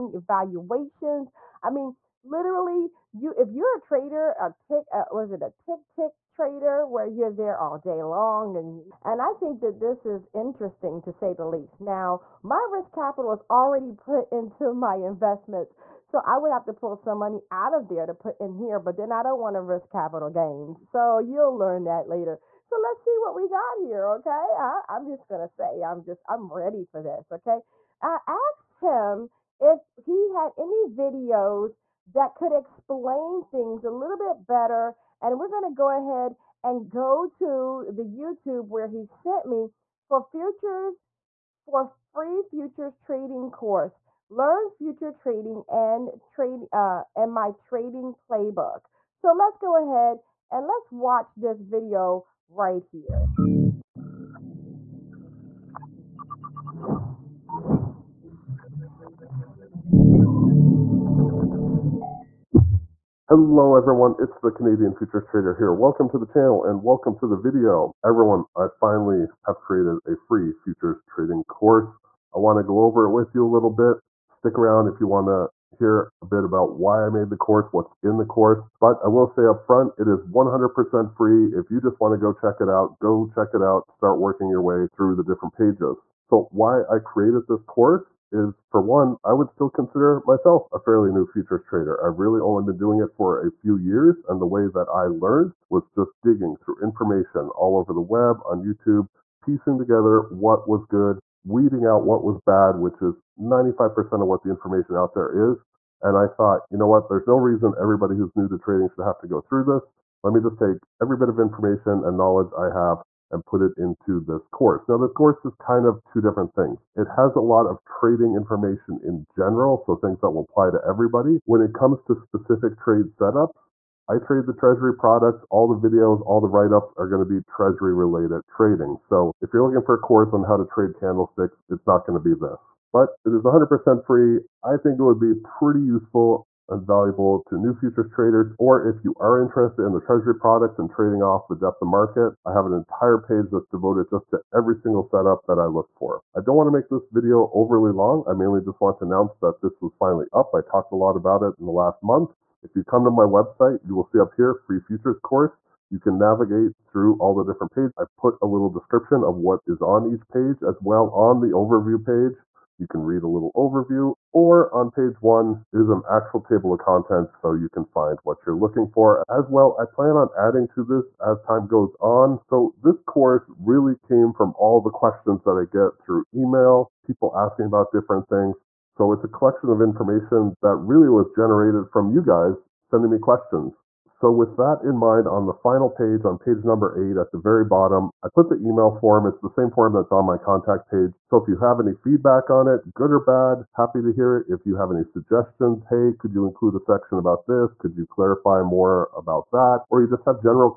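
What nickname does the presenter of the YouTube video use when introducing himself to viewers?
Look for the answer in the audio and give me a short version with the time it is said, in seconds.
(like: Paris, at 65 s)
Canadian Futures Trader, at 64 s.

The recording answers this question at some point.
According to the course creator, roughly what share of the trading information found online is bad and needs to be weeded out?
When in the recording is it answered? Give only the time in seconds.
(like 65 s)
103 s.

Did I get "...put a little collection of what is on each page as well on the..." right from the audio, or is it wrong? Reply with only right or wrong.
wrong.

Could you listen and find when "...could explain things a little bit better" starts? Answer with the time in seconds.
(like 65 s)
32 s.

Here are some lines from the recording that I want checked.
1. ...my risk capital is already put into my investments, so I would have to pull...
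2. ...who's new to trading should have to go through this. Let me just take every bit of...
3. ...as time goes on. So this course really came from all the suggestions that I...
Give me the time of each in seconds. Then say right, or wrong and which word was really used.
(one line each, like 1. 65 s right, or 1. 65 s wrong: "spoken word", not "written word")
1. 12 s right
2. 108 s right
3. 171 s wrong: "questions", not "suggestions".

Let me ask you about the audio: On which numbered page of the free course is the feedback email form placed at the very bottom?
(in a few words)
8.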